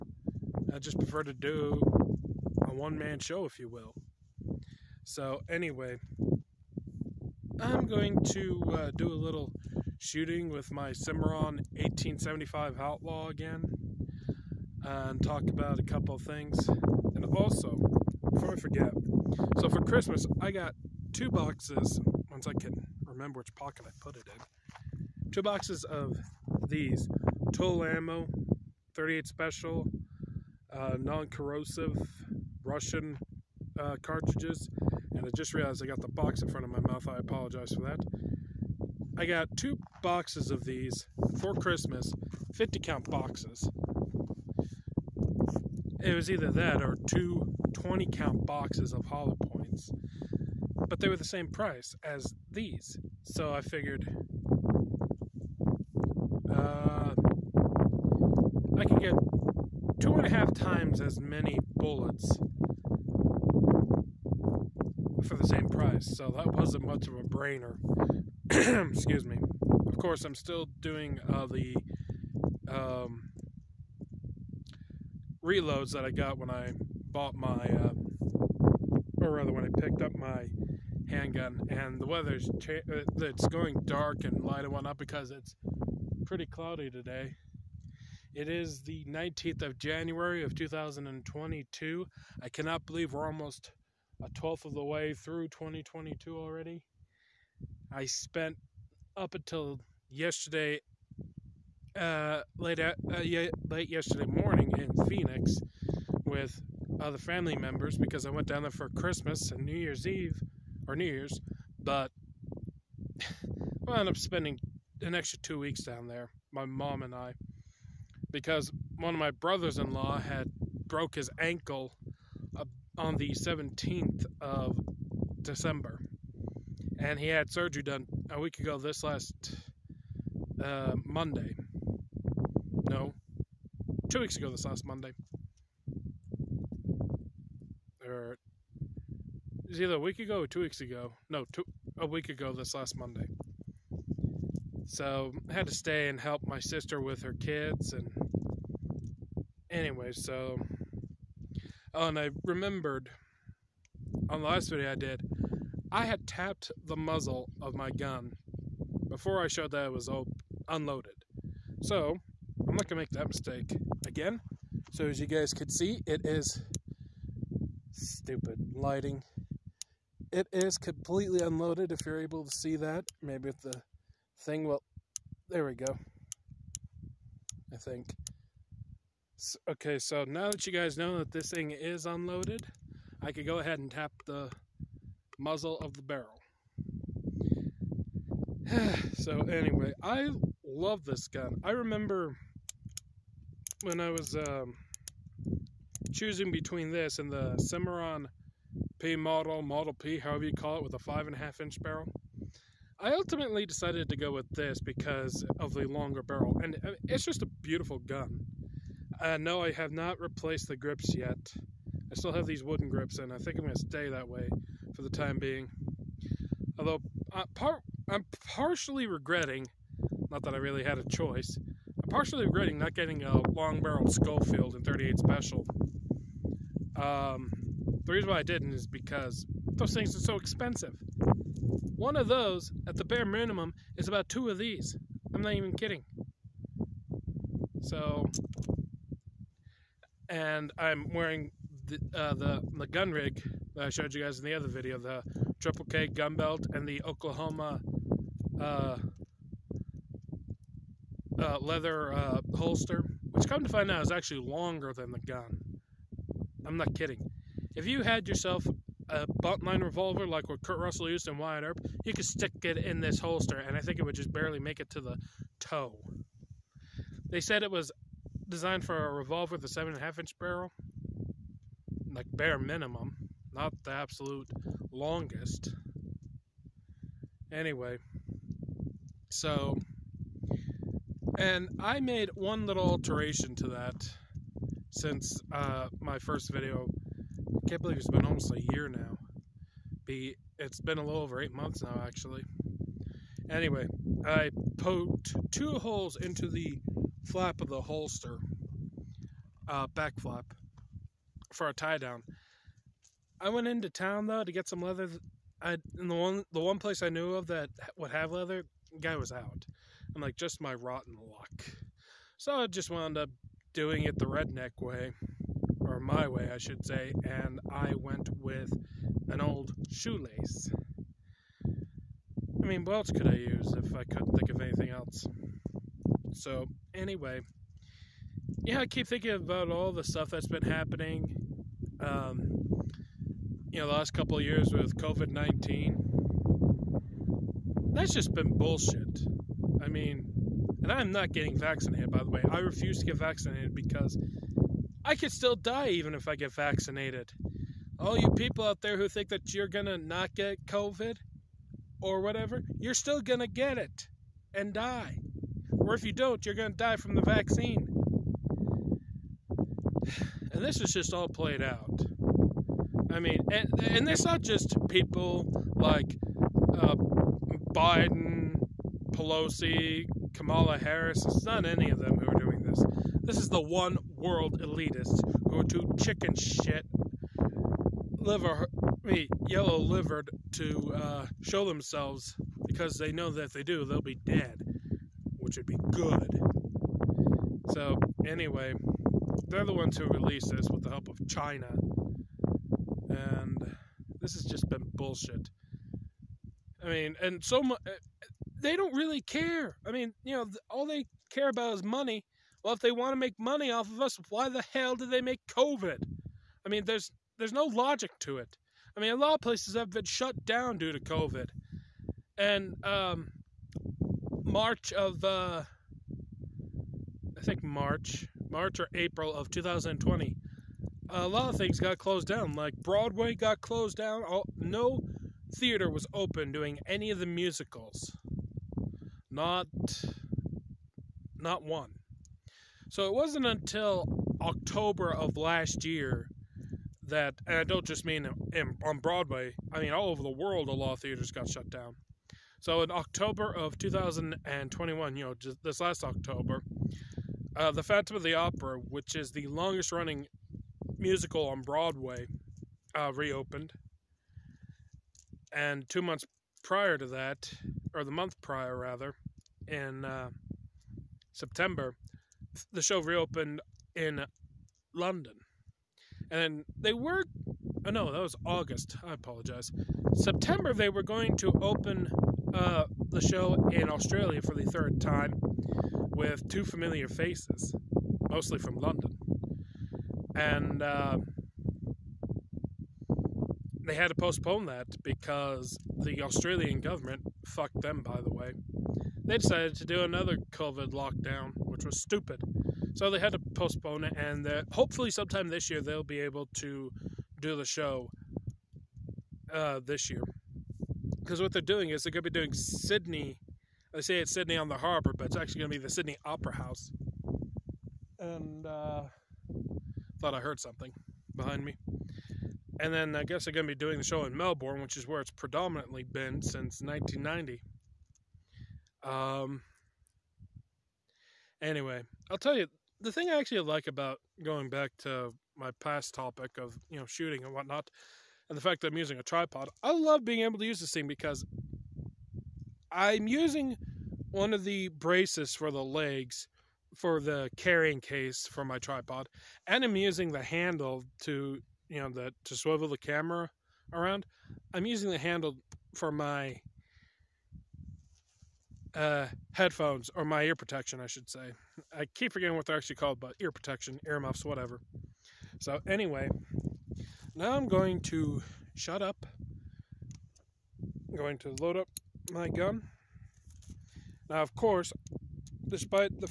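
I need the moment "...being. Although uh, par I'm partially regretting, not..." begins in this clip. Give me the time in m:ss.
3:35.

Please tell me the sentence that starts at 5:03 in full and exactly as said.
I went into town though to get some leather.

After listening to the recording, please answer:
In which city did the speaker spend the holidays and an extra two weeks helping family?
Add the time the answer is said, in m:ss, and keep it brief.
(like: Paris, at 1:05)
Phoenix, at 1:45.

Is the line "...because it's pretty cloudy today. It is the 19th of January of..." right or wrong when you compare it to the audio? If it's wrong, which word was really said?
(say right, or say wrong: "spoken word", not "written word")
right.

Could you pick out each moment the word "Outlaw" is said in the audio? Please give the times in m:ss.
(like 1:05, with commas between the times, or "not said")
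0:12.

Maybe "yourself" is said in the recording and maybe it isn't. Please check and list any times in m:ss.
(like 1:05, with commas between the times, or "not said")
4:18.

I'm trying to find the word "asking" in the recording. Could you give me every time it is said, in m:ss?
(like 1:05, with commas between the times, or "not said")
not said.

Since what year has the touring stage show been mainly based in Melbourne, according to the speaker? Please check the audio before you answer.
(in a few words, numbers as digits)
1990.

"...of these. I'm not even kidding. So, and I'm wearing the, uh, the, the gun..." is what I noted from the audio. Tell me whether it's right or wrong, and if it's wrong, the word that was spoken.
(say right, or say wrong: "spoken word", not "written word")
right.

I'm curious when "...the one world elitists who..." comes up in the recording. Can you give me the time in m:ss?
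6:13.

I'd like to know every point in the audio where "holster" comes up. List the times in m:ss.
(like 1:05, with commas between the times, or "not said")
4:12, 4:23, 4:57.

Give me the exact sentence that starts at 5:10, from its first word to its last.
I'm like, just my rotten luck.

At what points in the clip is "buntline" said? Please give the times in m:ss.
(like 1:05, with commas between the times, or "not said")
4:19.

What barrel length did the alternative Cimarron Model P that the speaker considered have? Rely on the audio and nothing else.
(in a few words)
5.5 inches.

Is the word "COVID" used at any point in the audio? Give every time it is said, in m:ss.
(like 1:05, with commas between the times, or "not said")
5:34, 5:50, 6:45, 6:50, 8:10.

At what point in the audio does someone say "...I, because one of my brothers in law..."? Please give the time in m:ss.
1:57.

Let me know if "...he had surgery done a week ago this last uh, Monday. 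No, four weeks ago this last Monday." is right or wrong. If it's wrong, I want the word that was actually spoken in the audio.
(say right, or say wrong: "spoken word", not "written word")
wrong: "two", not "four".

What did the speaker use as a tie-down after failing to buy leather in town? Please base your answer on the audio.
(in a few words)
an old shoelace.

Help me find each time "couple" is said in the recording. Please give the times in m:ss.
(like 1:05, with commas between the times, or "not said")
0:15, 5:34.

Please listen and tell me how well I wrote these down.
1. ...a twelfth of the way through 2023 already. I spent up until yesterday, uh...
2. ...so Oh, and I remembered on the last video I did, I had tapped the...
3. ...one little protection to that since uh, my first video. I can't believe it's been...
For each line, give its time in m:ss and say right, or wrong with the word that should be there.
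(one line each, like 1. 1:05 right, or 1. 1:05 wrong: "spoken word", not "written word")
1. 1:34 wrong: "2022", not "2023"
2. 2:30 right
3. 4:42 wrong: "alteration", not "protection".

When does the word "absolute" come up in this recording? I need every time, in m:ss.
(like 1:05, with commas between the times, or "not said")
4:33.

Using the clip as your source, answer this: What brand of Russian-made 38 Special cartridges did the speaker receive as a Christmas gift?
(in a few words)
TulAmmo.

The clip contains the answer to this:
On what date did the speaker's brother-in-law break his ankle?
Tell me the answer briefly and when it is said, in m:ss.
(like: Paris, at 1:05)
December 17, at 2:03.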